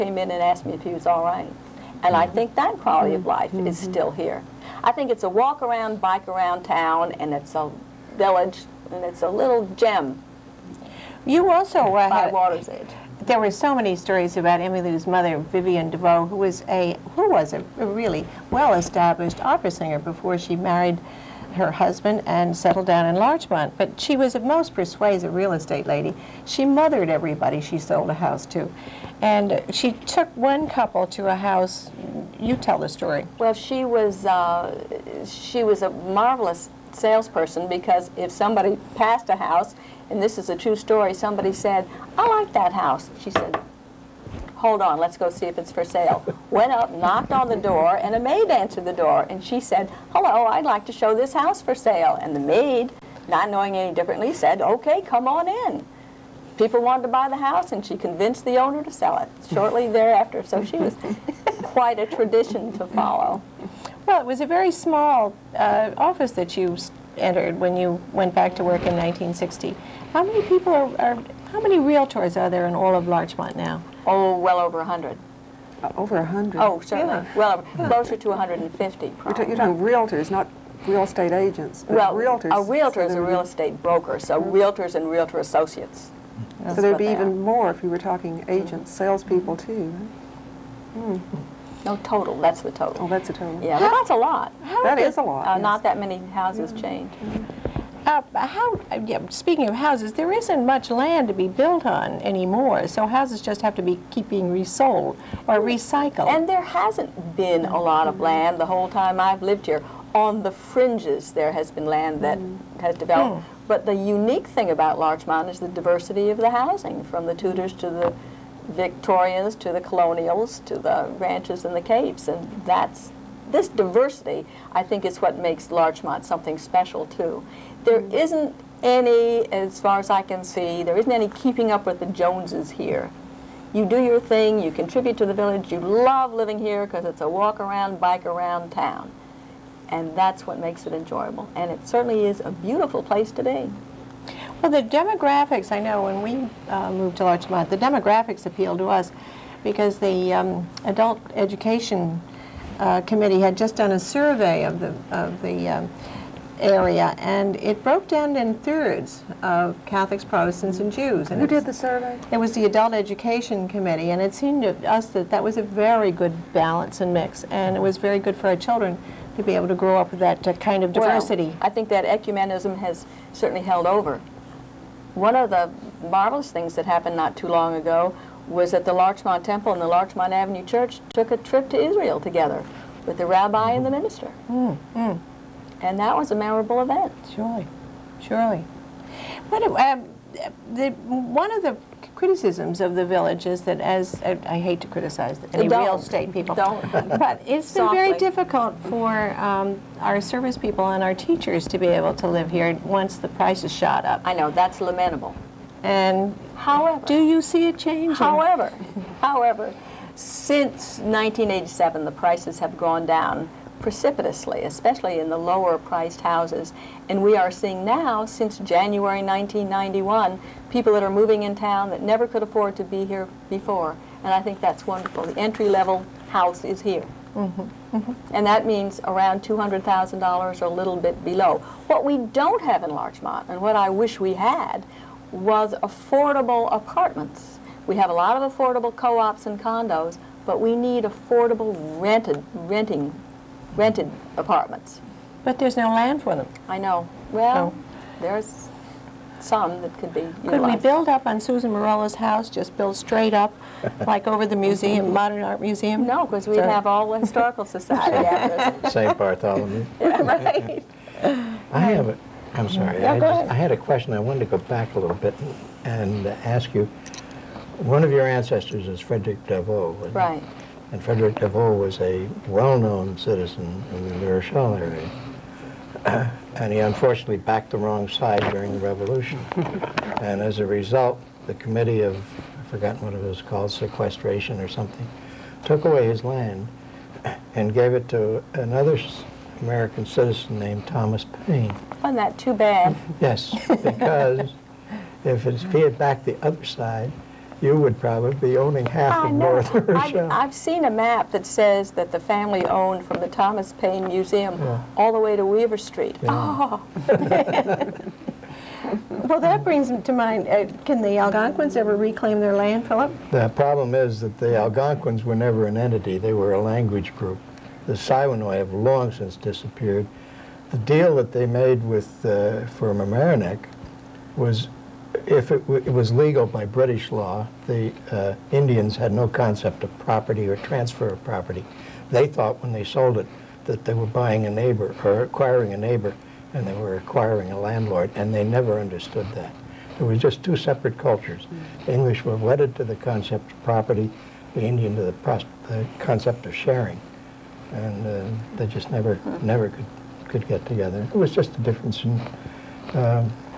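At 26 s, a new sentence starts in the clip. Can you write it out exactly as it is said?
She mothered everybody she sold a house to.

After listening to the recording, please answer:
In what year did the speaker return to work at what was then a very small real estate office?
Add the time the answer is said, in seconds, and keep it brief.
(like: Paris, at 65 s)
1960, at 68 s.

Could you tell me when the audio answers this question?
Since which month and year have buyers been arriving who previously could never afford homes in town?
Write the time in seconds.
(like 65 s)
218 s.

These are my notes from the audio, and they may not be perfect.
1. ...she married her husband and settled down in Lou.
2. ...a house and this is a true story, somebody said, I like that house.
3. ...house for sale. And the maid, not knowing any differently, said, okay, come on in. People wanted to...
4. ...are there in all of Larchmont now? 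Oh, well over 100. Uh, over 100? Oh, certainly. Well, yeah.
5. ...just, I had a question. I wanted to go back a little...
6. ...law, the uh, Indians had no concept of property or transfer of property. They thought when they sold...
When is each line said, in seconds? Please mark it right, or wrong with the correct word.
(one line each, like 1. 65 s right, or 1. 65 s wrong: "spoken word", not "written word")
1. 20 s wrong: "Larchmont", not "Lou"
2. 39 s right
3. 51 s right
4. 72 s right
5. 263 s right
6. 327 s right.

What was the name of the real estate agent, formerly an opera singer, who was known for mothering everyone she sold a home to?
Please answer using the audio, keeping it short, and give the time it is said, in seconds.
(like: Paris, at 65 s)
Vivian DeVoe, at 15 s.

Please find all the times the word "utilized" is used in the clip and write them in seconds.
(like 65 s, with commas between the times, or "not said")
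250 s.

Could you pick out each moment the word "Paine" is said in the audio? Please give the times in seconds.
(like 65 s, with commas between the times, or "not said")
291 s, 303 s.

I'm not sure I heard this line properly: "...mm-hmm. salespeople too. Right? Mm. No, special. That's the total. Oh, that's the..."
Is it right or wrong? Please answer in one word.
wrong.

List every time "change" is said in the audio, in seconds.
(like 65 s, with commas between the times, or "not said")
96 s, 207 s.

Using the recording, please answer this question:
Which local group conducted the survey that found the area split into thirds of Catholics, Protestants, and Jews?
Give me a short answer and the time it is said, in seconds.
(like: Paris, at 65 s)
Adult Education Committee, at 162 s.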